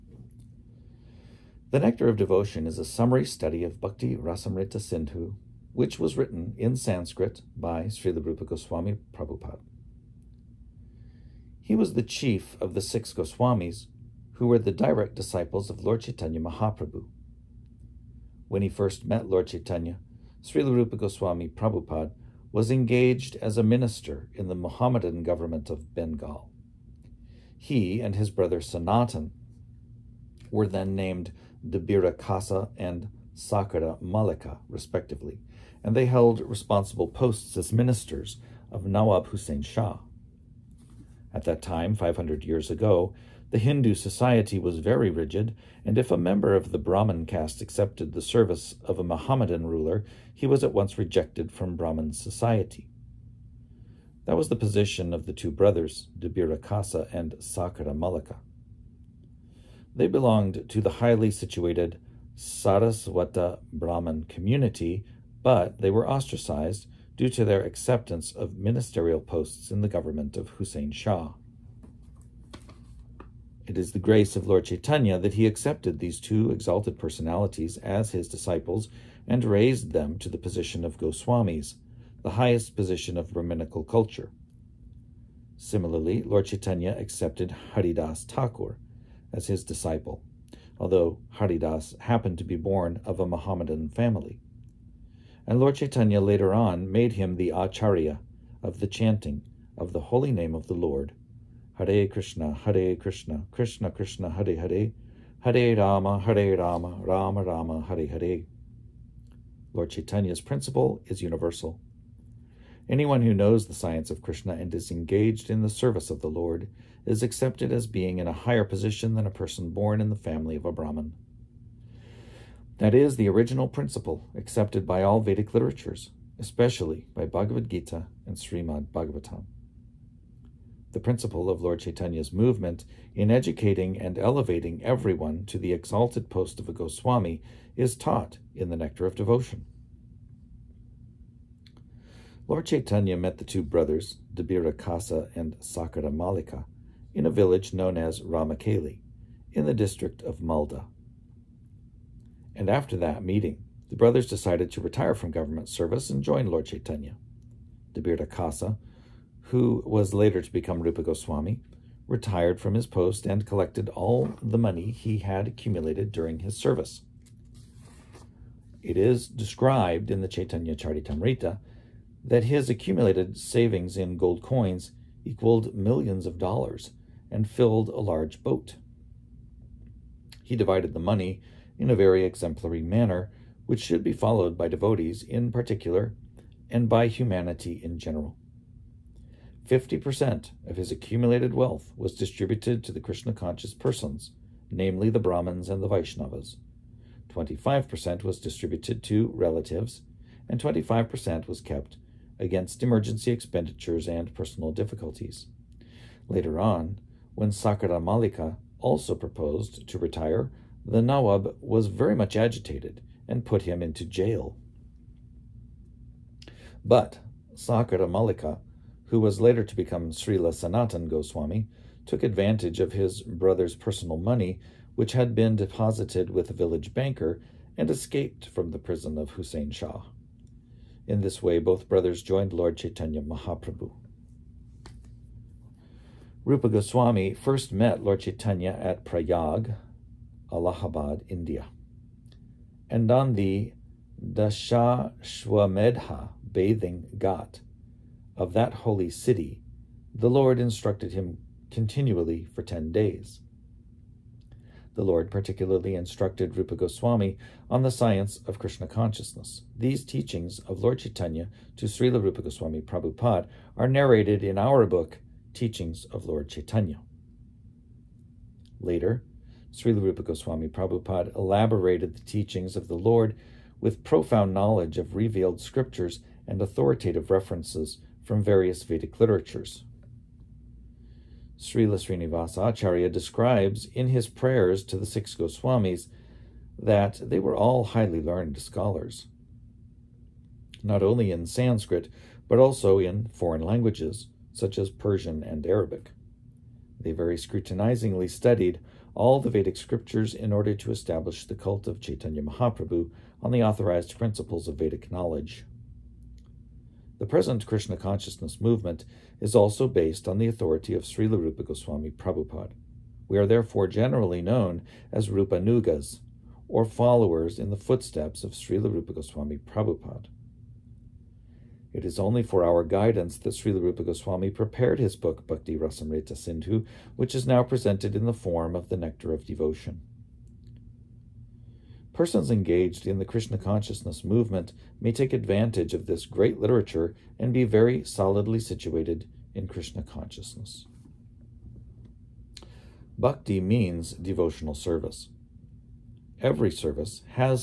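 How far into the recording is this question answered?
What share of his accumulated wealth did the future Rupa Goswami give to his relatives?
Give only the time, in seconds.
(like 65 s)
197 s.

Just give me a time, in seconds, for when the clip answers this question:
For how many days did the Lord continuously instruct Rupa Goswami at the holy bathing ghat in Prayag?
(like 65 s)
252 s.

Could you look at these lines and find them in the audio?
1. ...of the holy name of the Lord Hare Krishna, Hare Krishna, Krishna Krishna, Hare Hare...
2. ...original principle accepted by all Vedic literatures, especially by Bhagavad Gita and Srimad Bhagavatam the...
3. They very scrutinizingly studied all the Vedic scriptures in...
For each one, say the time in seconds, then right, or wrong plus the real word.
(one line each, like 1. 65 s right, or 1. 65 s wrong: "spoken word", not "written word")
1. 99 s right
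2. 123 s right
3. 296 s right.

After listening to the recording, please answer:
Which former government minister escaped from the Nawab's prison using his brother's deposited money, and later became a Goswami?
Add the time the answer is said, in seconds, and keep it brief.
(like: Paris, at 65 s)
Sanatan Goswami, at 220 s.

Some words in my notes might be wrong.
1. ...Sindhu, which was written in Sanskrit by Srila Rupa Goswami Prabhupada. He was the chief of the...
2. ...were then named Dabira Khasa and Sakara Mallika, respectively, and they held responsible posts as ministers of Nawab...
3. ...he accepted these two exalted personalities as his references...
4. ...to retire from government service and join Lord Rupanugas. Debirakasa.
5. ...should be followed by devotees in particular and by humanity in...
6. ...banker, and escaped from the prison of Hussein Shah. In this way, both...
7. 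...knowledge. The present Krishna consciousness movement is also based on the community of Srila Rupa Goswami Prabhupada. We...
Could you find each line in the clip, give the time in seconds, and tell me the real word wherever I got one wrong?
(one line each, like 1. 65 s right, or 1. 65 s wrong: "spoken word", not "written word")
1. 4 s right
2. 30 s right
3. 75 s wrong: "disciples", not "references"
4. 154 s wrong: "Chaitanya", not "Rupanugas"
5. 183 s right
6. 226 s right
7. 305 s wrong: "authority", not "community".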